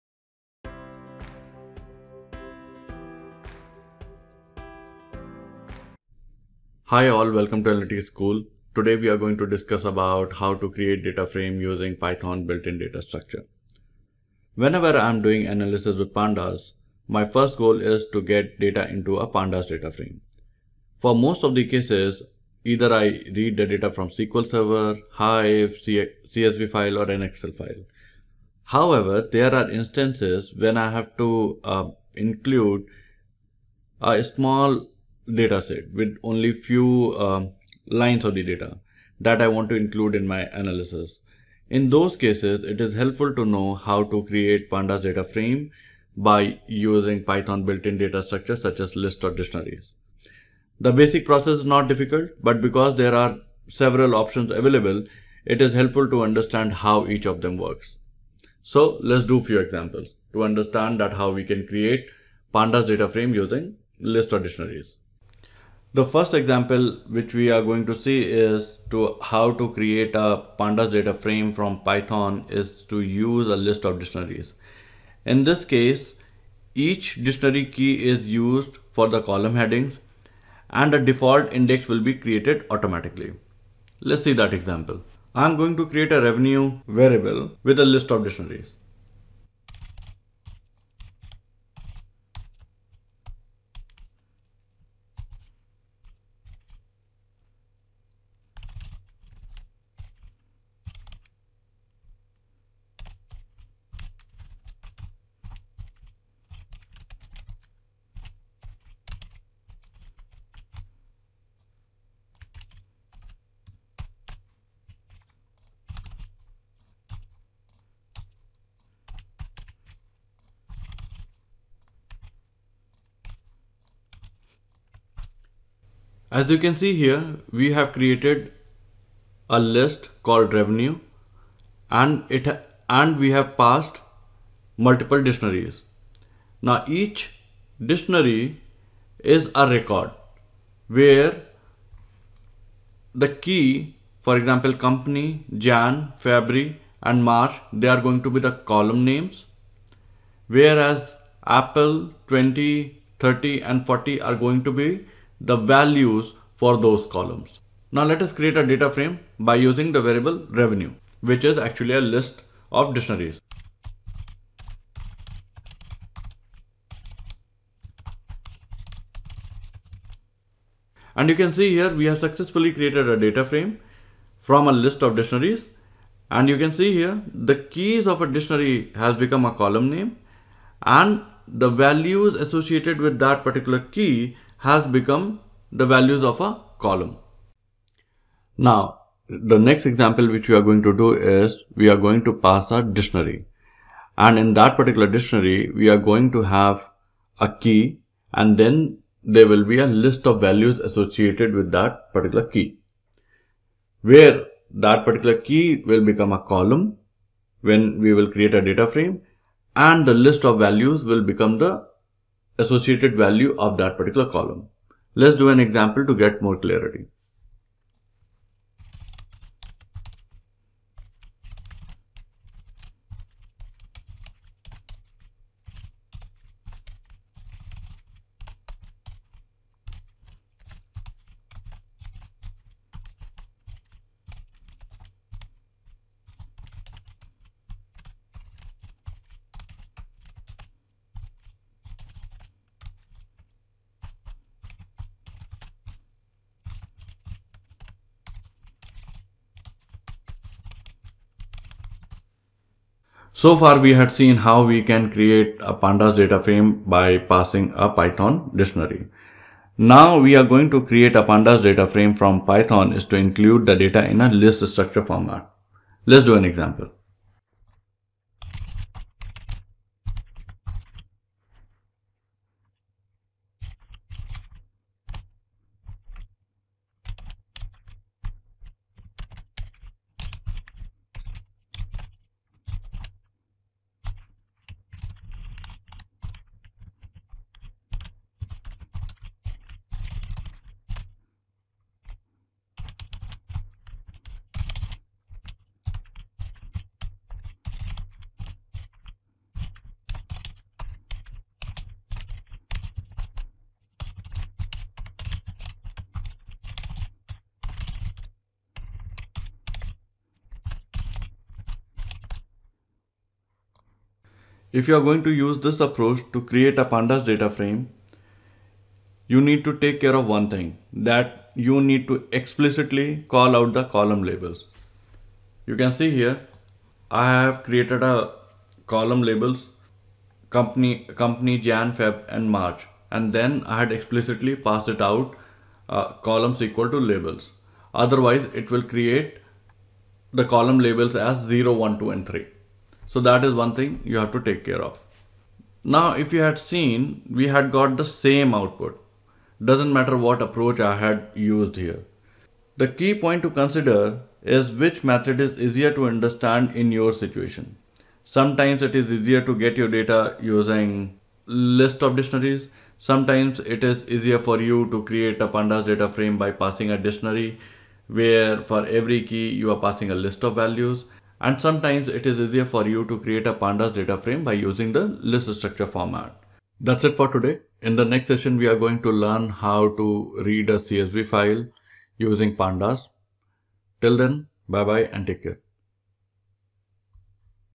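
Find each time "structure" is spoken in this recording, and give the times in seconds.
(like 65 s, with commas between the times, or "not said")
13 s, 48 s, 264 s, 375 s.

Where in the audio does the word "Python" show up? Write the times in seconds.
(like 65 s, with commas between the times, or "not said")
11 s, 47 s, 71 s, 257 s, 262 s.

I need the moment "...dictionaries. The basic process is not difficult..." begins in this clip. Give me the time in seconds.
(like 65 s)
49 s.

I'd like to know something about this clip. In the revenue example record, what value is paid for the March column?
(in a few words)
40.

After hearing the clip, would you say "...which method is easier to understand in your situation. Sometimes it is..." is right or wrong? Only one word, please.
right.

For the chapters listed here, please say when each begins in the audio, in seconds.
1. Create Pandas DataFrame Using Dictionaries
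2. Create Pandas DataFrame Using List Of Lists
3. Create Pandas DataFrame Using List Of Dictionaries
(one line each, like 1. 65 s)
1. 188 s
2. 255 s
3. 65 s.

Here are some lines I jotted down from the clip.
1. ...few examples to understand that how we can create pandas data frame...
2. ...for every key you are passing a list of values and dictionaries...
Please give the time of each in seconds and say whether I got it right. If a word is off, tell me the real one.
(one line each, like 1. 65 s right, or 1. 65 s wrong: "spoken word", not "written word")
1. 59 s right
2. 368 s wrong: "sometimes", not "dictionaries".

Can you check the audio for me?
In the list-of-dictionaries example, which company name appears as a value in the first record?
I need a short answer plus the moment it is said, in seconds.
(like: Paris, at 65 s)
Apple, at 151 s.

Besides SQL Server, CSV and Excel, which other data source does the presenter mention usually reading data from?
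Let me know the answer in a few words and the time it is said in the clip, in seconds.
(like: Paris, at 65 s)
Hive, at 25 s.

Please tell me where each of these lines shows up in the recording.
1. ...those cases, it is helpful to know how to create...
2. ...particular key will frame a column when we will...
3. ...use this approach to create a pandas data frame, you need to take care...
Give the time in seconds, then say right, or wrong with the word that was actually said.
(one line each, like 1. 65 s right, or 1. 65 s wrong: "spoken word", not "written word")
1. 41 s right
2. 205 s wrong: "become", not "frame"
3. 315 s right.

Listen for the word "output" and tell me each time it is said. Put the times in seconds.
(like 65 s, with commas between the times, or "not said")
348 s.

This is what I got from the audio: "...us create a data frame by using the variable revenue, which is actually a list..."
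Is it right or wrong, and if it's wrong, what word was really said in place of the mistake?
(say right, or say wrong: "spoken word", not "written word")
right.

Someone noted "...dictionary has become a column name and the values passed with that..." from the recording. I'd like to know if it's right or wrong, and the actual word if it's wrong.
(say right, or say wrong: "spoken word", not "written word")
wrong: "associated", not "passed".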